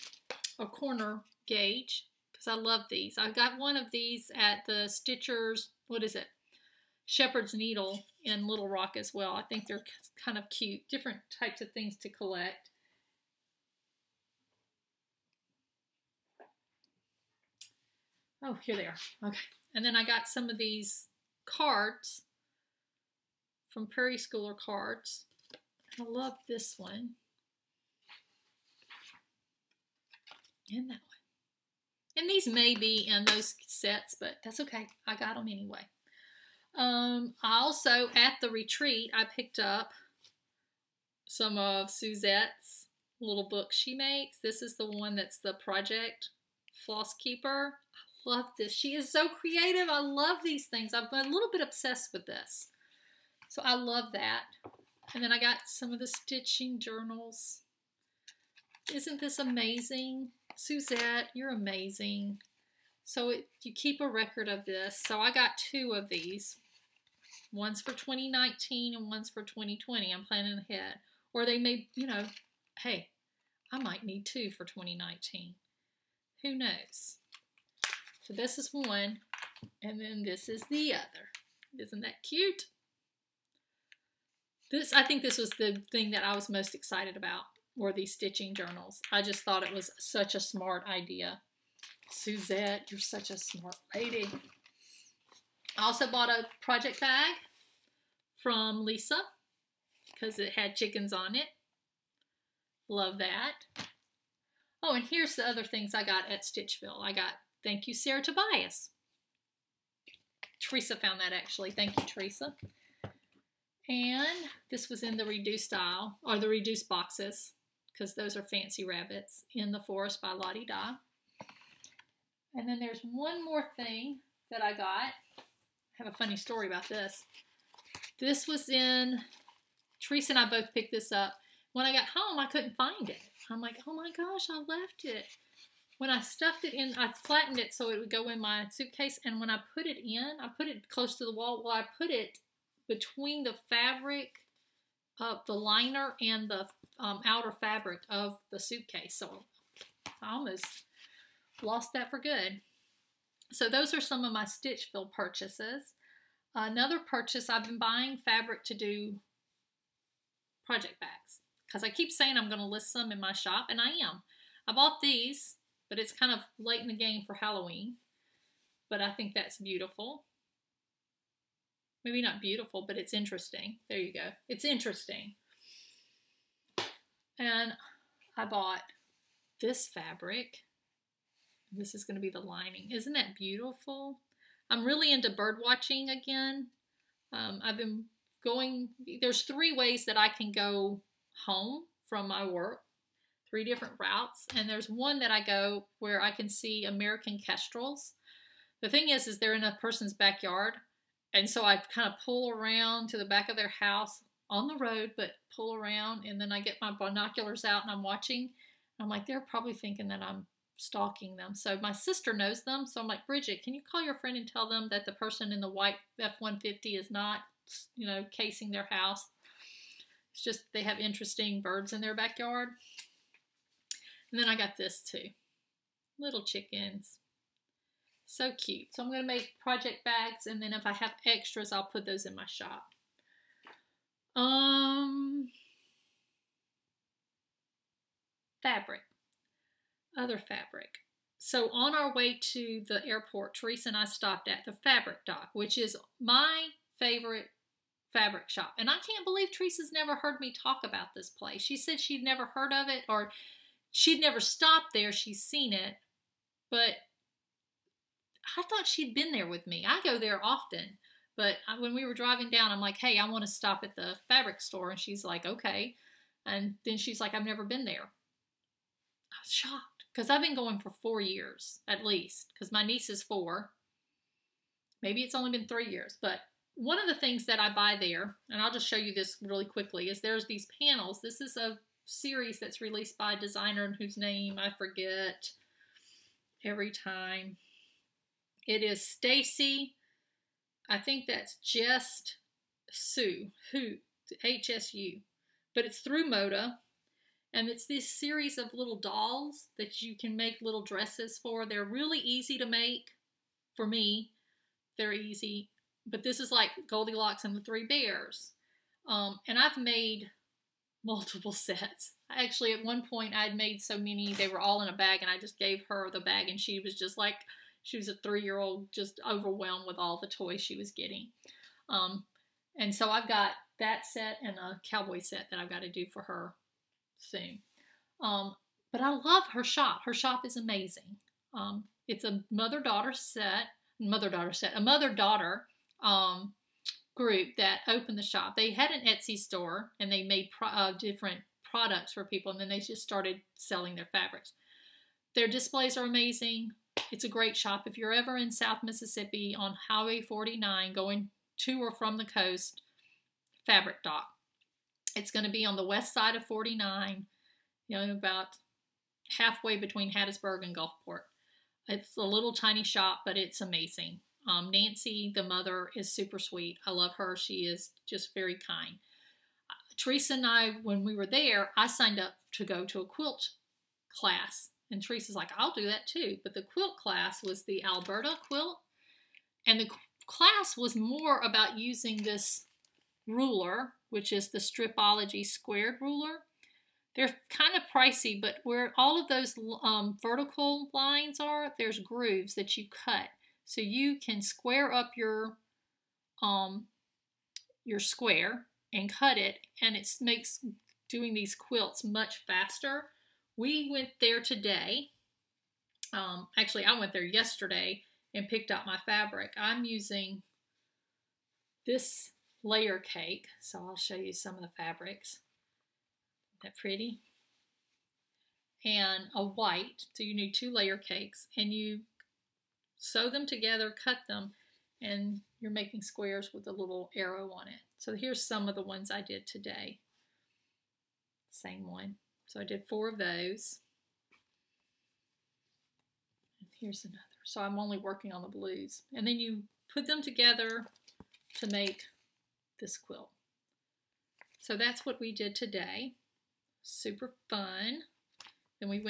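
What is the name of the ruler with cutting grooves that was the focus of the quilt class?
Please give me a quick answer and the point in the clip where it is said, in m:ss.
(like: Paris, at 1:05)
Stripology squared, at 6:24.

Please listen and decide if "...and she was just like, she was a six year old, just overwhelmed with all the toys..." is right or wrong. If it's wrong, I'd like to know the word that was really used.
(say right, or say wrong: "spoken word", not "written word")
wrong: "three", not "six".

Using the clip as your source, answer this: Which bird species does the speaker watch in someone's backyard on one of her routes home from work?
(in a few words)
American kestrels.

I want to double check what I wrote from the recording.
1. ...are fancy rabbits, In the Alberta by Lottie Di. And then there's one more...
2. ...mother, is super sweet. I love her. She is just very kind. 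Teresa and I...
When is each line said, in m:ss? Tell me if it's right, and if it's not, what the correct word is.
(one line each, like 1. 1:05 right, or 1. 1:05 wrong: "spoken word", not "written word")
1. 1:58 wrong: "Forest", not "Alberta"
2. 6:05 right.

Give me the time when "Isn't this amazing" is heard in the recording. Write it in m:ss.
0:58.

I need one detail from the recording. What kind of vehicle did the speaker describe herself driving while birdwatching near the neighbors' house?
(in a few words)
White F-150.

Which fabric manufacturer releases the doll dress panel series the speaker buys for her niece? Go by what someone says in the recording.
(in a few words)
Moda.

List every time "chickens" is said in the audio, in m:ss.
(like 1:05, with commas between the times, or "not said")
1:40, 3:46.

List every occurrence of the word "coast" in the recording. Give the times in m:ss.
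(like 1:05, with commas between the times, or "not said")
5:52.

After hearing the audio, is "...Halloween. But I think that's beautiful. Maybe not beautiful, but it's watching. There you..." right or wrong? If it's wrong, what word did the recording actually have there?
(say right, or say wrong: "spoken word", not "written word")
wrong: "interesting", not "watching".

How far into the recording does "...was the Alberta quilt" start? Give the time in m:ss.
6:17.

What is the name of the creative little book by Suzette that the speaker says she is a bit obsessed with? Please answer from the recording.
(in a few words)
Project Floss Keeper.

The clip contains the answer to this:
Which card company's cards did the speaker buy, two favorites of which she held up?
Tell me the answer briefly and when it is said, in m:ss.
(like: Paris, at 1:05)
Prairie Schooler, at 0:23.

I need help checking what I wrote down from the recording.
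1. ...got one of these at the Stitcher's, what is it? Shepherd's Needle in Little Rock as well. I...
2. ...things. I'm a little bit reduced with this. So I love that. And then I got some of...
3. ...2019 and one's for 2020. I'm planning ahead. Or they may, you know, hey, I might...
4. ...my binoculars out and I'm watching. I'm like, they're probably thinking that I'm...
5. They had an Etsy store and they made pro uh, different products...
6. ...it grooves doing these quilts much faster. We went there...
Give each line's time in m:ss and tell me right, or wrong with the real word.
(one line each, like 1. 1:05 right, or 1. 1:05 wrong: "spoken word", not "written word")
1. 0:03 right
2. 0:50 wrong: "obsessed", not "reduced"
3. 1:07 right
4. 3:26 right
5. 5:38 right
6. 6:39 wrong: "makes", not "grooves".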